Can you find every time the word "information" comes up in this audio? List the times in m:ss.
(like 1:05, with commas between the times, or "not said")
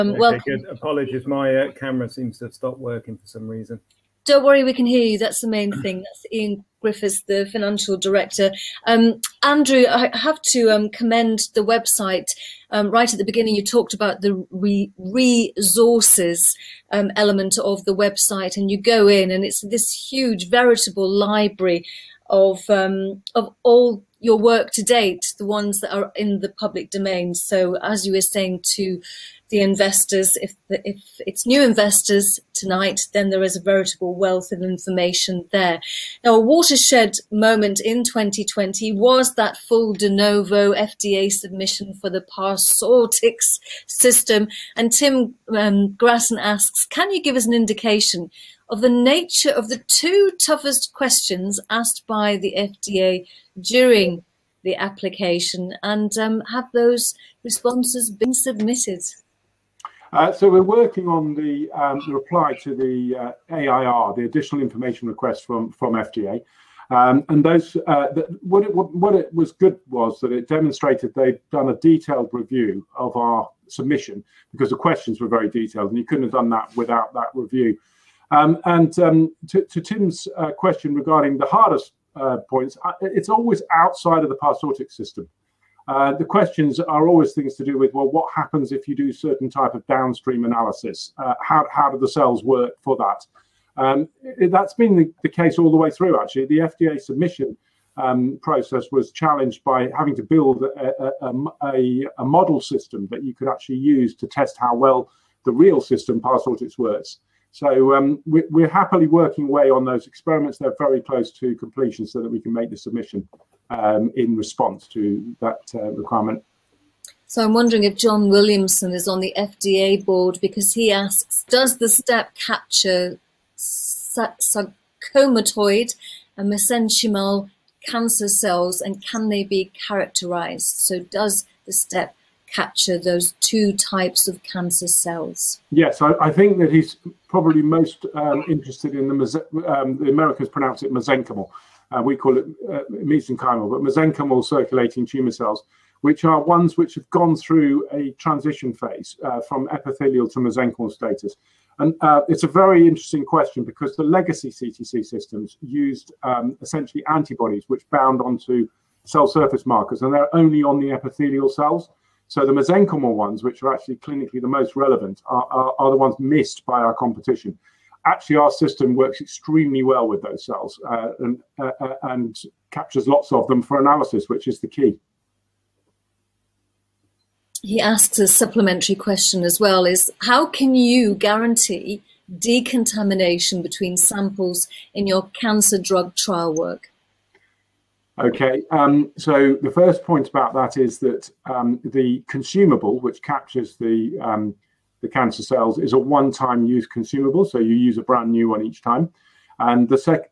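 0:34, 1:04.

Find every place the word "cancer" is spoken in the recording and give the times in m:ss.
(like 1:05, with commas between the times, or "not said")
2:07, 2:14, 3:05, 3:15.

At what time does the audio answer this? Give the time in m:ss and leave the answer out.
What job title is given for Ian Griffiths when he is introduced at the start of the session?
0:07.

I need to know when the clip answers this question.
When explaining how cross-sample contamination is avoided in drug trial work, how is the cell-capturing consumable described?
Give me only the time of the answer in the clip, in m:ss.
3:15.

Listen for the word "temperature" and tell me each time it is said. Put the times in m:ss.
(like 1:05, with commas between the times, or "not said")
not said.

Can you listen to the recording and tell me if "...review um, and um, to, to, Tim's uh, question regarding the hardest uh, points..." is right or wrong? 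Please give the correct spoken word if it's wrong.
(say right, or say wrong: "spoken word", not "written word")
right.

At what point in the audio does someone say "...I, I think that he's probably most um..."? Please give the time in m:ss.
2:16.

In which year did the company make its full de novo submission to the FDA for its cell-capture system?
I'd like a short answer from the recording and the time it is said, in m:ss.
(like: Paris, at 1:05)
2020, at 0:38.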